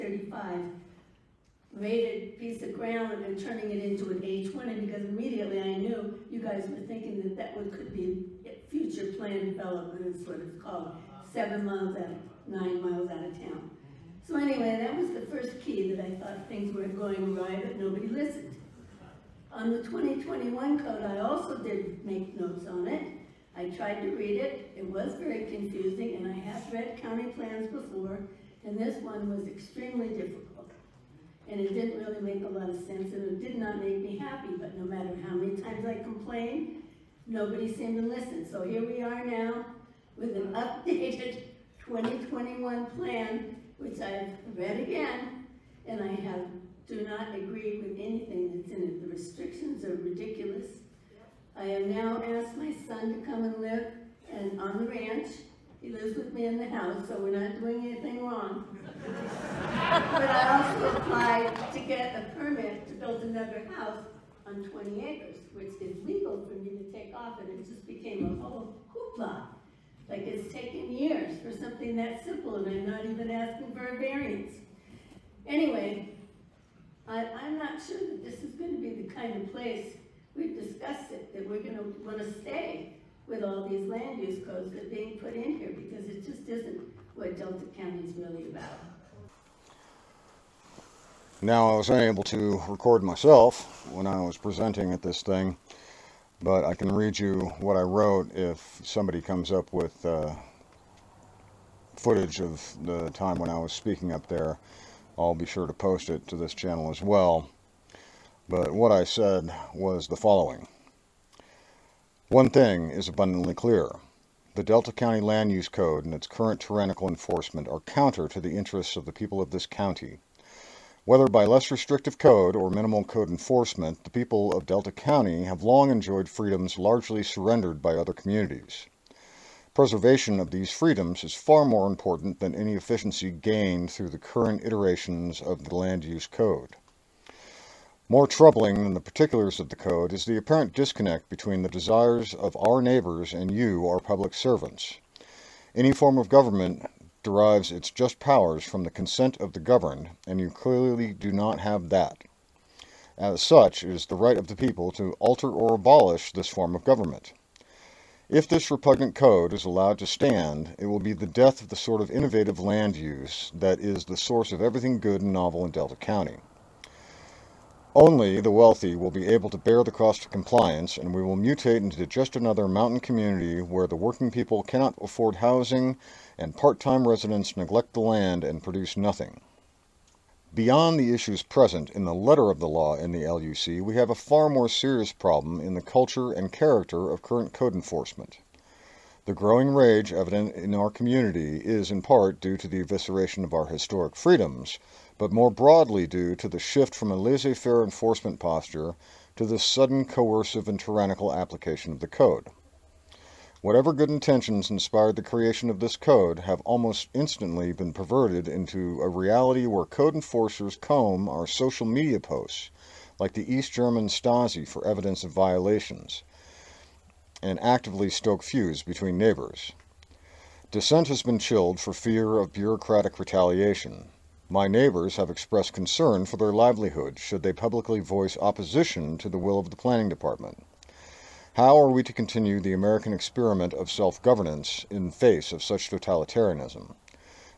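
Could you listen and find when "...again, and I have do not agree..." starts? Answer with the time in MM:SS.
00:44.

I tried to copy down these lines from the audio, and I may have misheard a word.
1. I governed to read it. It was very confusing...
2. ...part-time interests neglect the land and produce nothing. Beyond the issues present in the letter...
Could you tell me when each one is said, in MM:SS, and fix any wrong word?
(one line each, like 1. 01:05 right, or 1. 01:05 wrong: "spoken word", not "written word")
1. 00:23 wrong: "tried", not "governed"
2. 02:56 wrong: "residents", not "interests".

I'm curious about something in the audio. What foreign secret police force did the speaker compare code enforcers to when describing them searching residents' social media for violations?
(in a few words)
East German Stasi.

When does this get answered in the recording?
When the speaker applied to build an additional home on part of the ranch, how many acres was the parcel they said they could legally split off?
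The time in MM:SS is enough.
01:04.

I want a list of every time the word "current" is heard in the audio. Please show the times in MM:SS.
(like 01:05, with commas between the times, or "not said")
01:56, 02:14, 03:07.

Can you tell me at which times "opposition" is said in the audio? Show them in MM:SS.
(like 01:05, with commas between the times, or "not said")
03:48.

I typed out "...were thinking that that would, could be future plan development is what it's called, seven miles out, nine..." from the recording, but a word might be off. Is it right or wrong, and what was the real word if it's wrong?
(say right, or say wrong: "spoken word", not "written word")
right.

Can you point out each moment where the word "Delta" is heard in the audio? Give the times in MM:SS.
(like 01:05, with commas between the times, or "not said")
01:27, 01:54, 02:04, 02:45.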